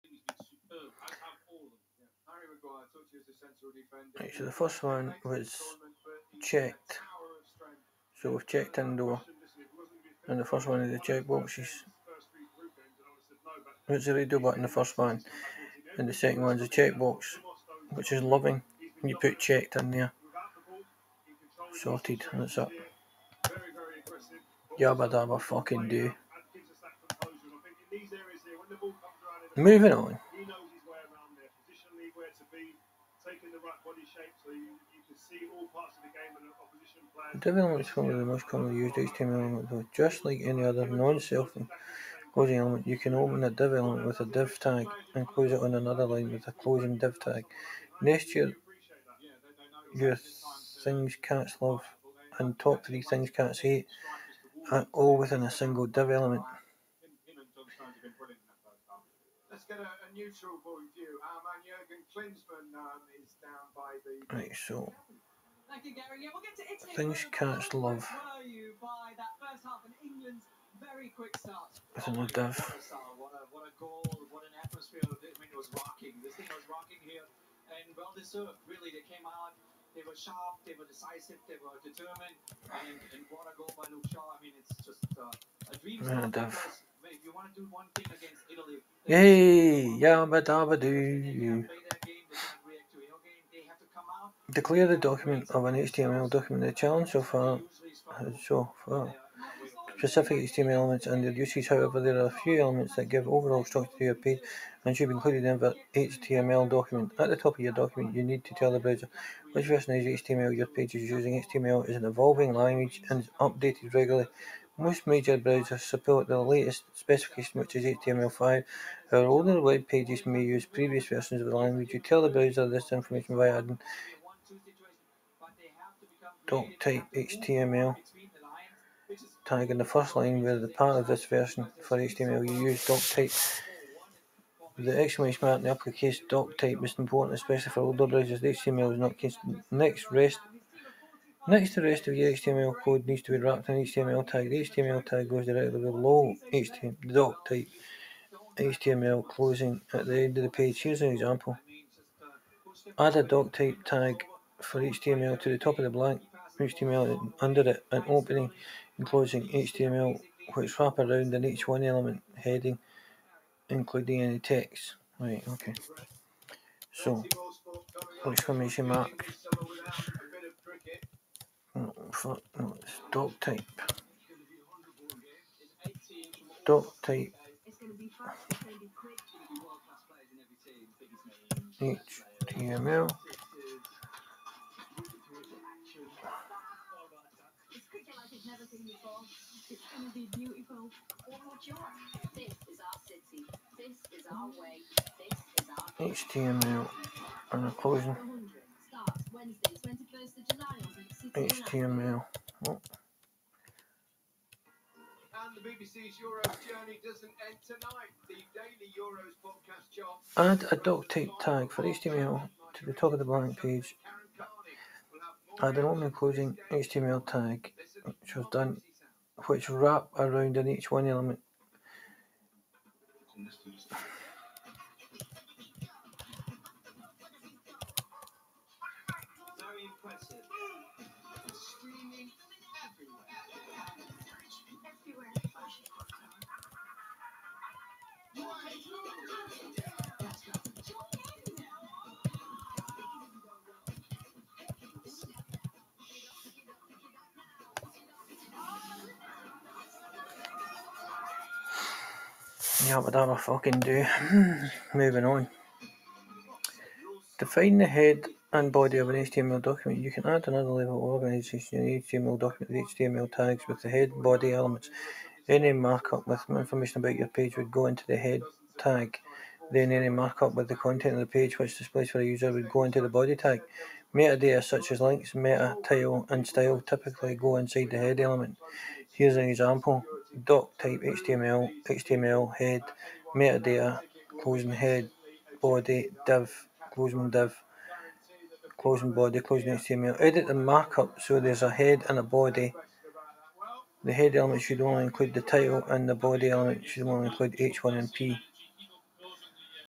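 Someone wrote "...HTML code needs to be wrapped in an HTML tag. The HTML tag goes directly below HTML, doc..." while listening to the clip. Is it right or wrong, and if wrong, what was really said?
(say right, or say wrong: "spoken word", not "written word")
right.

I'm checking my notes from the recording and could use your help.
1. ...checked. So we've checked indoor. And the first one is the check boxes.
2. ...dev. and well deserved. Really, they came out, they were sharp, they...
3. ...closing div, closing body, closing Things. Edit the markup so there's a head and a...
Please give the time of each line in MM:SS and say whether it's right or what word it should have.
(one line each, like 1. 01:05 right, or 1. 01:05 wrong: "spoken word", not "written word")
1. 00:06 right
2. 01:12 right
3. 04:46 wrong: "HTML", not "Things".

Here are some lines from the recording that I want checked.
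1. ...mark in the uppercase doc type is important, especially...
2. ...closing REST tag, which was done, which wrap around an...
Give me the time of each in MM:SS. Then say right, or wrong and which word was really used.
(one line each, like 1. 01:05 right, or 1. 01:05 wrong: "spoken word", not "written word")
1. 02:15 right
2. 03:36 wrong: "HTML", not "REST".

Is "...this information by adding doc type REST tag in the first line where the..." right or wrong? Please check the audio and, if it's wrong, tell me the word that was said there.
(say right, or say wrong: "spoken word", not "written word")
wrong: "HTML", not "REST".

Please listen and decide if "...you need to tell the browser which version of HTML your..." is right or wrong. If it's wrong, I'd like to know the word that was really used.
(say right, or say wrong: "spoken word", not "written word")
right.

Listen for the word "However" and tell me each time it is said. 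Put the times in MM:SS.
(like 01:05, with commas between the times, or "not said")
01:41, 01:59.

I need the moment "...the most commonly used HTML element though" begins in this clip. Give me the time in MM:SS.
00:38.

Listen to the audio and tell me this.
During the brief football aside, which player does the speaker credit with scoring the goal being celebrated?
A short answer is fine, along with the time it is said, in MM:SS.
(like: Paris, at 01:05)
Luke Shaw, at 01:23.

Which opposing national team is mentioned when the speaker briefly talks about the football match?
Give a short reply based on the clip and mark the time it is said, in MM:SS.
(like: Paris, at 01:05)
Italy, at 01:28.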